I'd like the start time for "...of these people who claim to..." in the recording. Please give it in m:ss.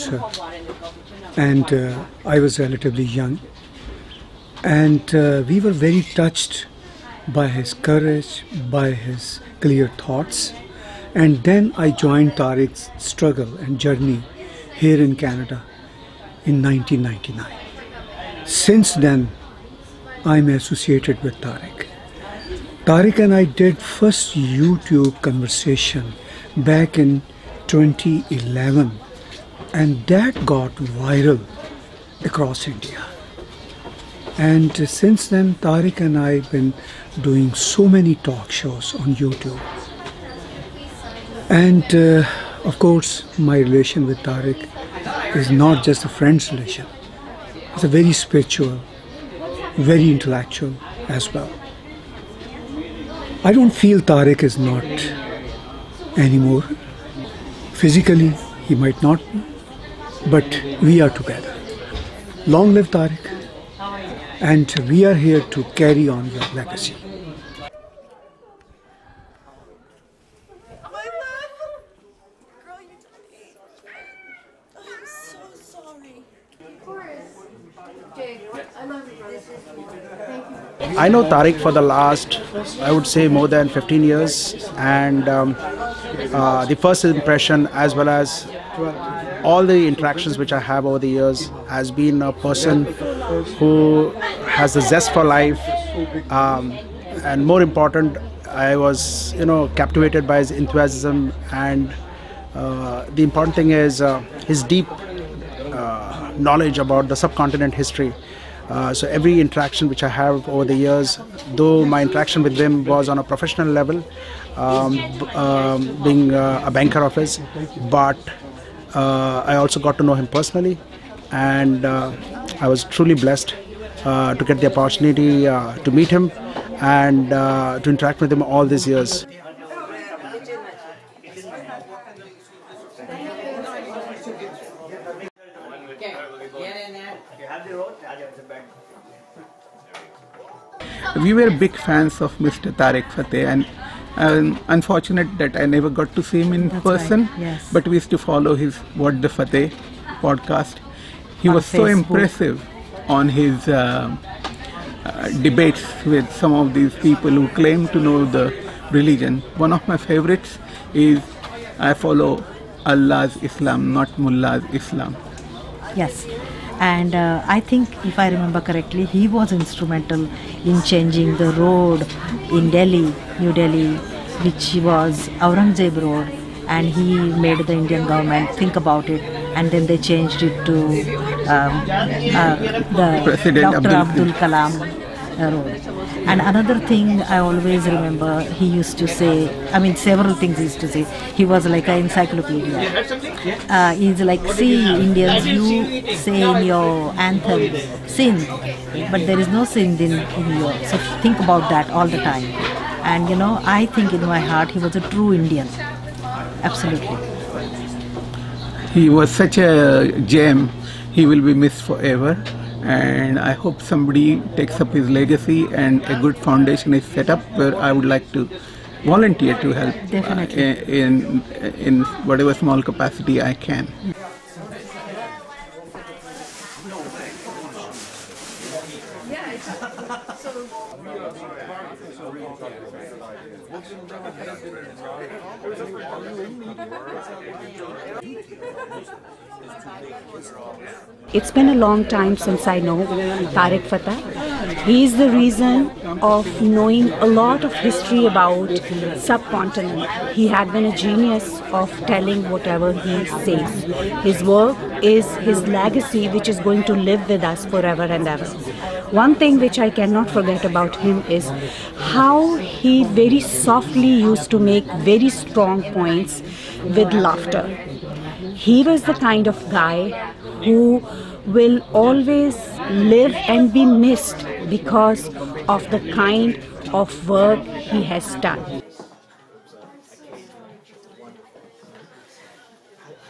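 2:36.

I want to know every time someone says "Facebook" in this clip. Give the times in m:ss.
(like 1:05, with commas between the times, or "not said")
2:31.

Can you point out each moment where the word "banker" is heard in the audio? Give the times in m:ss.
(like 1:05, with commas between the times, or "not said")
1:56.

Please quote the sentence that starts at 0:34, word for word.
And since then, Tarek and I have been doing so many talk shows on YouTube.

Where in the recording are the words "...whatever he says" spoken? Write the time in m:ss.
4:12.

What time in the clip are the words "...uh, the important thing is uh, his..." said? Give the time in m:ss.
1:42.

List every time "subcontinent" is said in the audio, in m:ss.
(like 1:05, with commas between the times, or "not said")
1:47, 4:09.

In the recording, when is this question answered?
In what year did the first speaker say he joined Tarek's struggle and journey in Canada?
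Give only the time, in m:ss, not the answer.
0:16.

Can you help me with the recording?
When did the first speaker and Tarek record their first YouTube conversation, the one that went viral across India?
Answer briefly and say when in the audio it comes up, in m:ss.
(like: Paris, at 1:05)
2011, at 0:27.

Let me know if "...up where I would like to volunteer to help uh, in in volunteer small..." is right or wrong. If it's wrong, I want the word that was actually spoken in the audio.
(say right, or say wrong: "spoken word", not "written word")
wrong: "whatever", not "volunteer".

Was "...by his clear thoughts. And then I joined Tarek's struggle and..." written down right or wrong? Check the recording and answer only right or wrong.
right.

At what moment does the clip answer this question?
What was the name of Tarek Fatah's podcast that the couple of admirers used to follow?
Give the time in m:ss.
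2:28.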